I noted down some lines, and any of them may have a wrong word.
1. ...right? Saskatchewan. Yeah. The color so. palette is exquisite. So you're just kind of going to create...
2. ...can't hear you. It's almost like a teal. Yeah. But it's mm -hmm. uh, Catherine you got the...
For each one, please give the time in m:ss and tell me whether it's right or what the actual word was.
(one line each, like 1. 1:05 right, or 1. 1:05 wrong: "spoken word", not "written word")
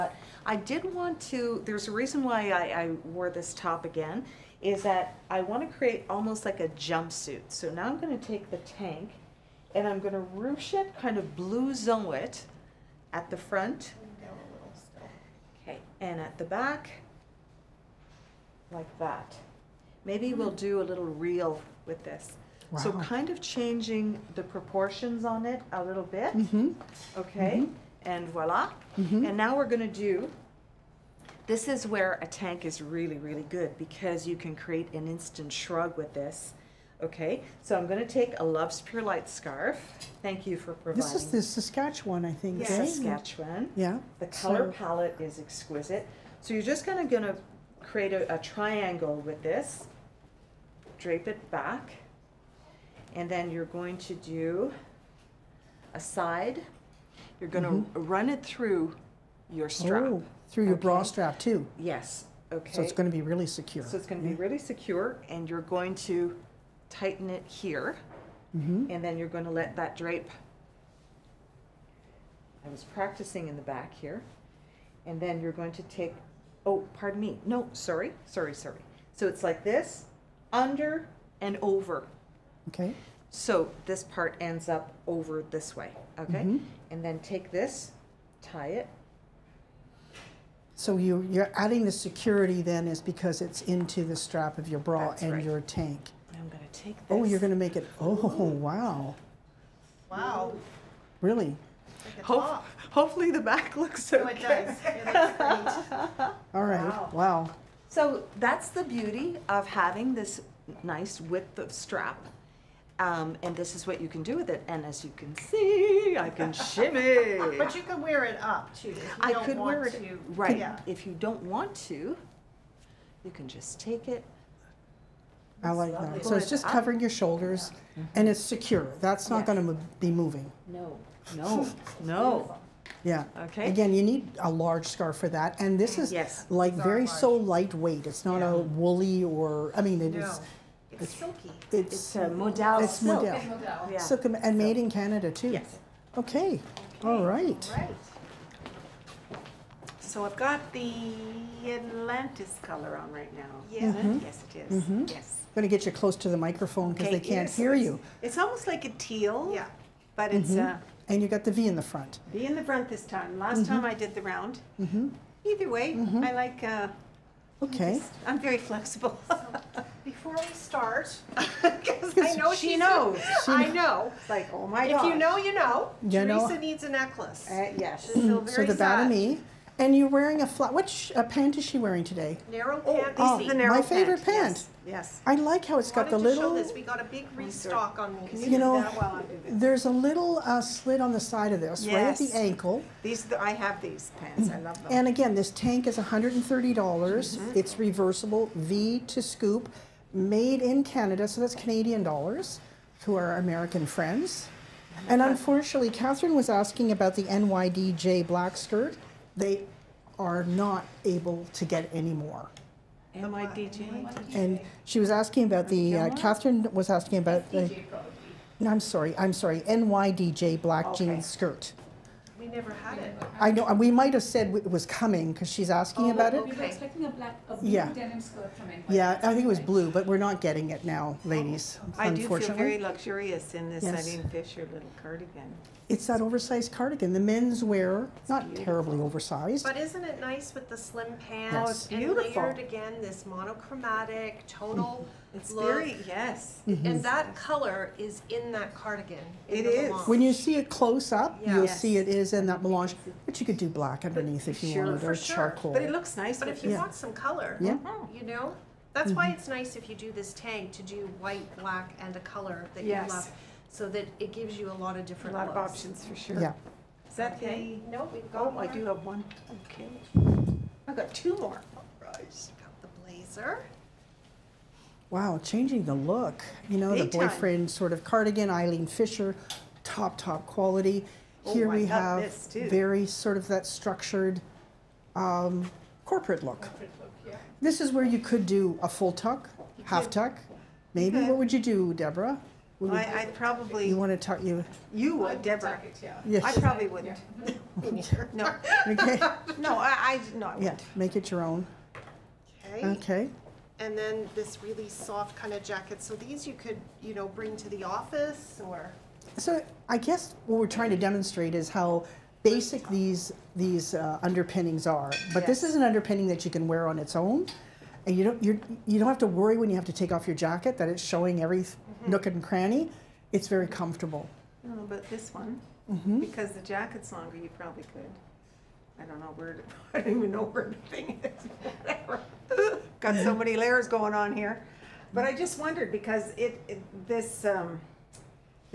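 1. 0:42 right
2. 2:37 wrong: "And", not "Catherine".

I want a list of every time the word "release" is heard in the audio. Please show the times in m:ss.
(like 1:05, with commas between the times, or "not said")
not said.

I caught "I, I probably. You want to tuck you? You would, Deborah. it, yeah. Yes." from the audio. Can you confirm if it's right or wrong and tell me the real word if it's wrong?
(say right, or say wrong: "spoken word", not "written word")
right.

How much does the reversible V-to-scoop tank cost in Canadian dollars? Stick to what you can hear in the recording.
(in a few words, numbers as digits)
130 dollars.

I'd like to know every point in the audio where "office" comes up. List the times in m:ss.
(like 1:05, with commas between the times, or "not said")
5:07.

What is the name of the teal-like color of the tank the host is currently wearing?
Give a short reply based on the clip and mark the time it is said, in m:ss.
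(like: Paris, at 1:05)
Atlantis, at 2:31.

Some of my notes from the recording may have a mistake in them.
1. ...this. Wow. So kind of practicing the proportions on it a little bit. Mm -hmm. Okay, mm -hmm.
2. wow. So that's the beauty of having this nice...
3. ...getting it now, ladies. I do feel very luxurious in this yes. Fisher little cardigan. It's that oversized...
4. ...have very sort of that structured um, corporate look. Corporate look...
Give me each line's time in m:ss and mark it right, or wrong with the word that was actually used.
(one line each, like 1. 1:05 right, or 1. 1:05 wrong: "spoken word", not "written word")
1. 0:22 wrong: "changing", not "practicing"
2. 1:47 right
3. 3:50 right
4. 4:41 right.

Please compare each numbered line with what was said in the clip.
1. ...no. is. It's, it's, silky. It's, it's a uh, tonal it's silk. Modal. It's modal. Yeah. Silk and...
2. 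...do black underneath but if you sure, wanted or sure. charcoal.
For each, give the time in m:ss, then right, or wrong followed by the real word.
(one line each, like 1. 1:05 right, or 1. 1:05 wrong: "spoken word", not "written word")
1. 2:20 wrong: "modal", not "tonal"
2. 4:13 right.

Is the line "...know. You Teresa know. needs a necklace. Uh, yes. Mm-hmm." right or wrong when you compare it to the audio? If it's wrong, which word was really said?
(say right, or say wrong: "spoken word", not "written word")
right.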